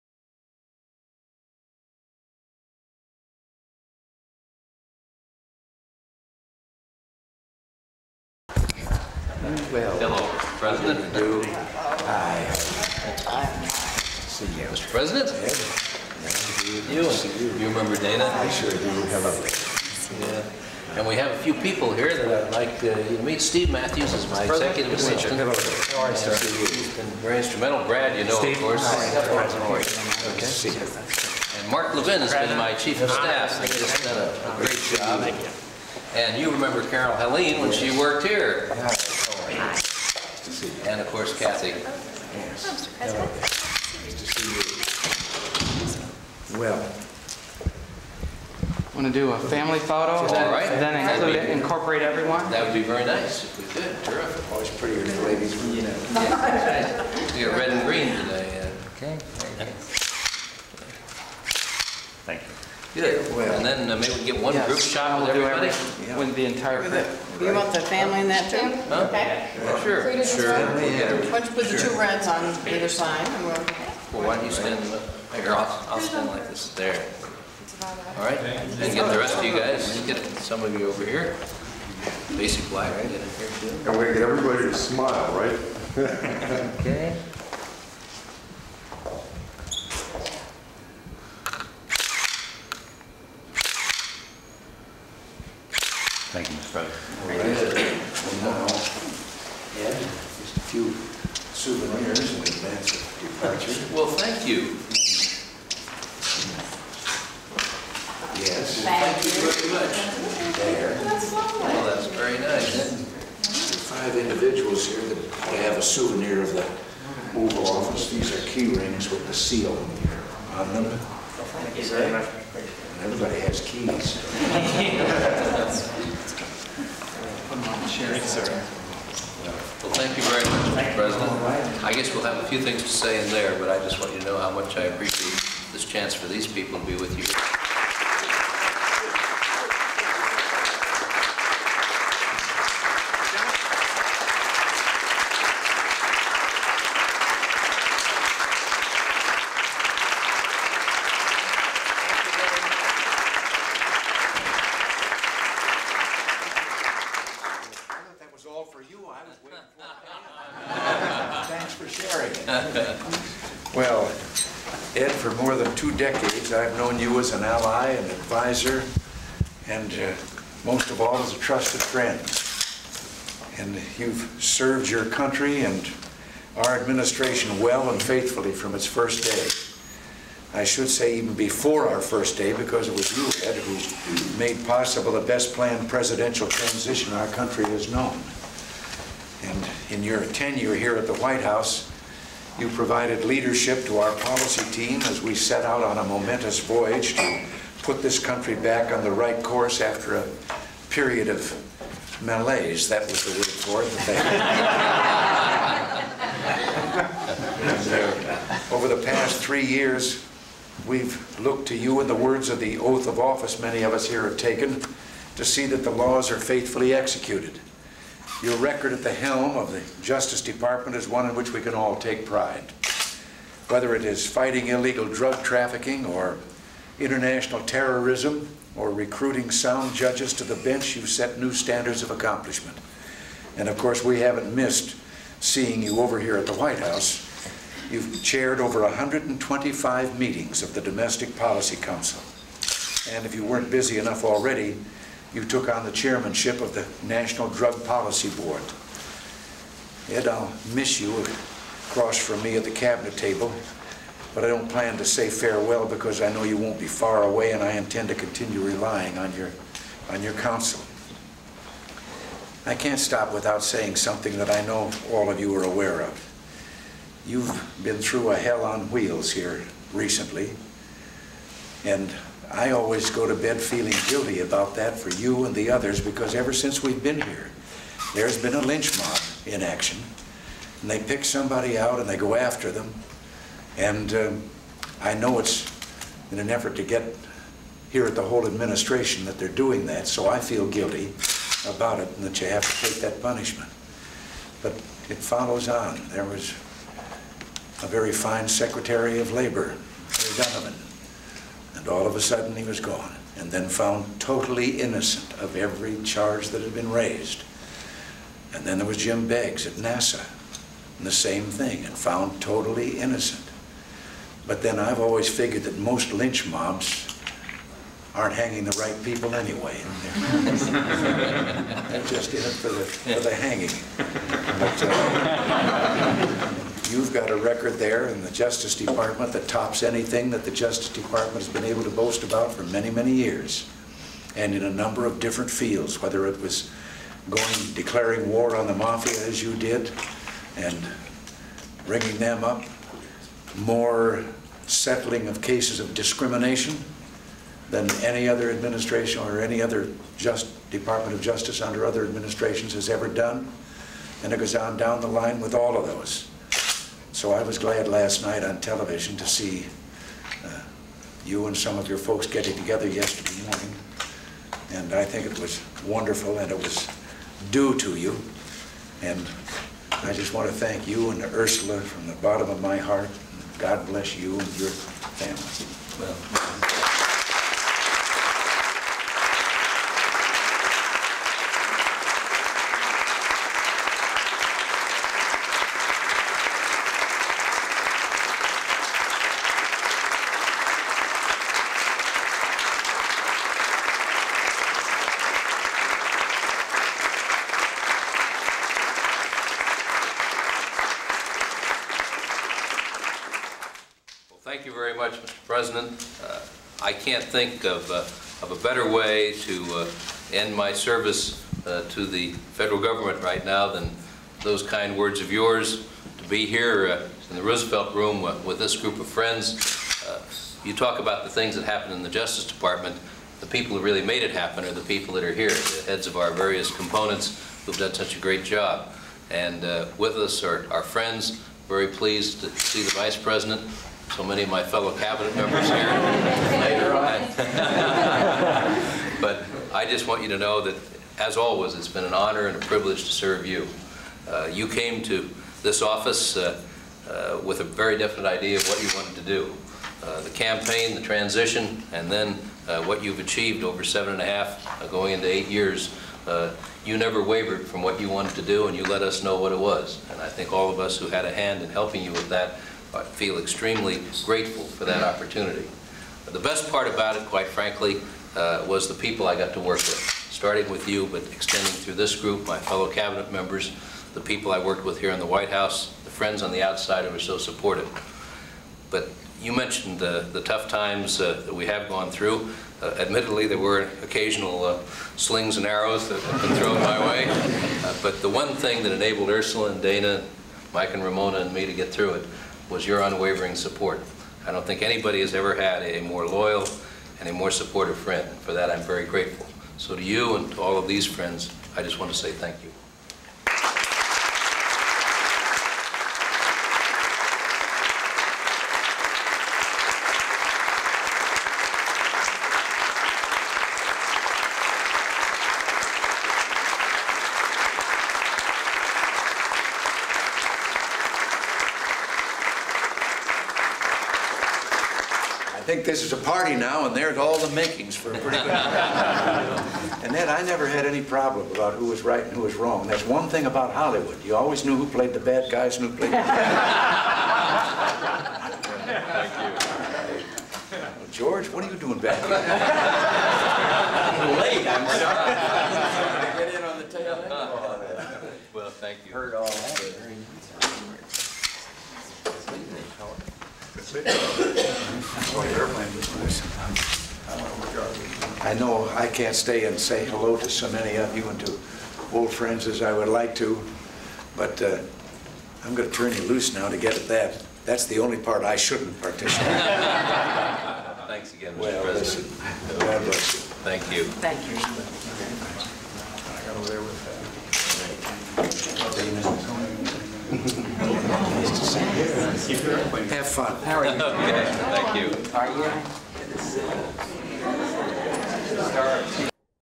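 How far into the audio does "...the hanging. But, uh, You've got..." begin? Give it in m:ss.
5:23.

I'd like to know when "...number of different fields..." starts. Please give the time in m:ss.
5:34.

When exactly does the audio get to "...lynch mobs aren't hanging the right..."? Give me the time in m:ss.
5:16.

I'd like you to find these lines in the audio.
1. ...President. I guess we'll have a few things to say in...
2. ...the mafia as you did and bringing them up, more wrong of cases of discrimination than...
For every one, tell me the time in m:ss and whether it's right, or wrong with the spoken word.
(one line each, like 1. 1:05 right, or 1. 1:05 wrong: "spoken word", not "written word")
1. 2:10 right
2. 5:38 wrong: "settling", not "wrong".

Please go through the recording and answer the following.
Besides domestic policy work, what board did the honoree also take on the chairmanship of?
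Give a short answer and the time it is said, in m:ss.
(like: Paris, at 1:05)
National Drug Policy Board, at 4:07.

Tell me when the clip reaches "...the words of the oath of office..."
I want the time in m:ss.
3:32.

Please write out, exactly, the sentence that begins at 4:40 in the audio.
And they pick somebody out and they go after them.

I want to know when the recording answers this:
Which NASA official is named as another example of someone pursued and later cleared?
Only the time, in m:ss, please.
5:08.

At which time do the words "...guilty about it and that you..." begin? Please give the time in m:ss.
4:50.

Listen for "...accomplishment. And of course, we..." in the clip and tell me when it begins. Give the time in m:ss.
3:52.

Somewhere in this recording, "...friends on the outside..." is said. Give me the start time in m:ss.
7:56.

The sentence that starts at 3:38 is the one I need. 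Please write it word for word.
Your record at the helm of the Justice Department is one in which we can all take pride.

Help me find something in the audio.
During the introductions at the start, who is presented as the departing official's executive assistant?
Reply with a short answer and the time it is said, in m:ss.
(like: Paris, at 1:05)
Steve Matthews, at 0:23.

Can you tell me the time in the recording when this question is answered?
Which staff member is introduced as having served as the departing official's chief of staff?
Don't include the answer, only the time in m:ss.
0:31.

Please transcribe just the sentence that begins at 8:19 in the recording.
So to you and to all of these friends, I just want to say thank you.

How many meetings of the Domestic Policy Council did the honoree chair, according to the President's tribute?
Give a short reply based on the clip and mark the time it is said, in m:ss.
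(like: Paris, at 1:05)
Over 125, at 3:58.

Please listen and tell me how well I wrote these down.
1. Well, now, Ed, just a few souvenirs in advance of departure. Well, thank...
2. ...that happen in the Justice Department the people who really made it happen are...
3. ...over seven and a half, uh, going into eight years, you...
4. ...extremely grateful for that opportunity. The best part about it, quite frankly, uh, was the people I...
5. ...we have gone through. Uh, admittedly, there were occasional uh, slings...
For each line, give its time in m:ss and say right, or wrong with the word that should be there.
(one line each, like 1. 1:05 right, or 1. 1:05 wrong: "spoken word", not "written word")
1. 1:38 right
2. 7:01 right
3. 7:33 right
4. 7:43 right
5. 8:01 right.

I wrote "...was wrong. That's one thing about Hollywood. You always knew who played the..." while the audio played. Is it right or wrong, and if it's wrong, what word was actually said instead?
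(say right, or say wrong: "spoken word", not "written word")
right.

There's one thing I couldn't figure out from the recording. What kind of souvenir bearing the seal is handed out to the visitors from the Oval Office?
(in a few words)
Key rings.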